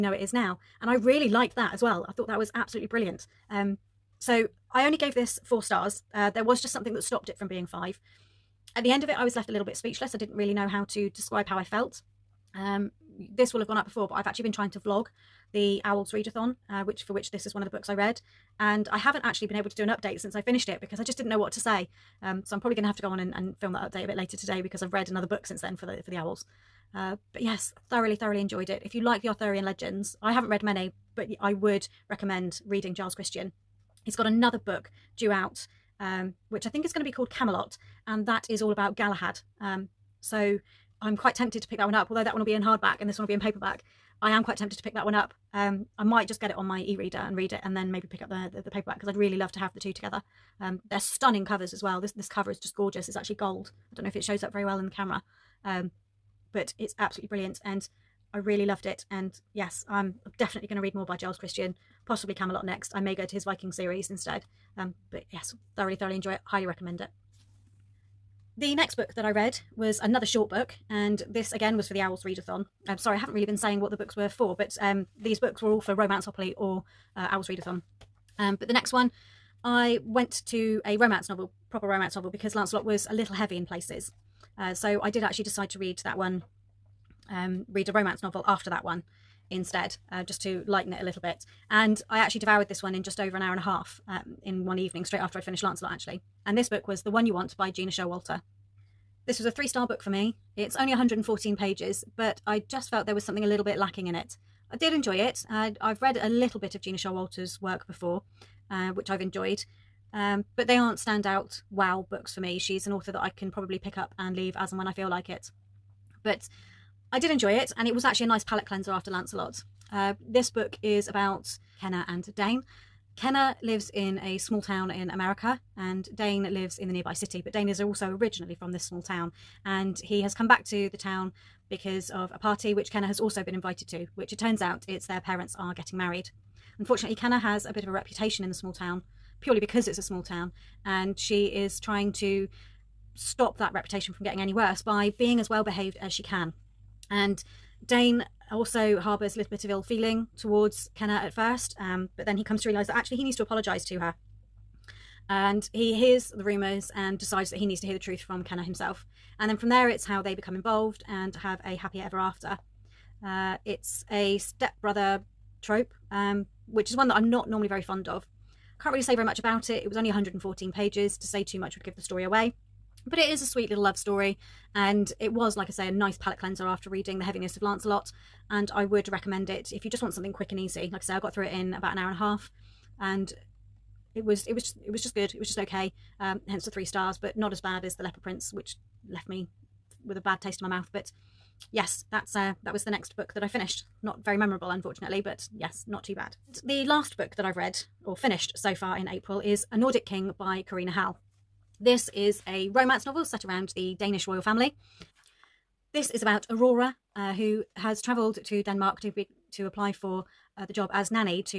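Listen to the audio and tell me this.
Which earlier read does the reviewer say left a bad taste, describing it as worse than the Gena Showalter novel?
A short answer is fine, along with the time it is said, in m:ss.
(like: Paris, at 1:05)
The Leopard Prince, at 3:08.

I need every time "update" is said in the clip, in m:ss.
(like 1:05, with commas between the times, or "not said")
0:19, 0:23.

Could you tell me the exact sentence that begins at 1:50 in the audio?
Um, but they aren't standout wow books for me.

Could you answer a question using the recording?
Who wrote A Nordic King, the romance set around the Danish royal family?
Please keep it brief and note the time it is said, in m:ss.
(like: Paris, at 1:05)
Karina Halle, at 3:20.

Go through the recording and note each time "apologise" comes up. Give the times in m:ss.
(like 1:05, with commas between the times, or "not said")
2:33.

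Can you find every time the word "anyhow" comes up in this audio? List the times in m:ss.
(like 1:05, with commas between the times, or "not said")
not said.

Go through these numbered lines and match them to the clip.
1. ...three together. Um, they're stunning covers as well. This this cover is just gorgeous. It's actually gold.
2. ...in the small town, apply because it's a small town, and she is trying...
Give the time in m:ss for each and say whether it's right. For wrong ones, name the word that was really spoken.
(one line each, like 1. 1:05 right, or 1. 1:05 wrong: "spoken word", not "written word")
1. 0:49 wrong: "two", not "three"
2. 2:18 wrong: "purely", not "apply".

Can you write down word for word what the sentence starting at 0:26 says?
Uh, but yes, thoroughly, thoroughly enjoyed it.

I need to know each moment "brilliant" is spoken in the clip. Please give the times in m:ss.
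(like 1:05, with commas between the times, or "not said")
0:02, 0:57.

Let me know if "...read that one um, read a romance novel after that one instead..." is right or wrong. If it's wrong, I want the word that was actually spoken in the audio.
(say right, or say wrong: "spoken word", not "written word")
right.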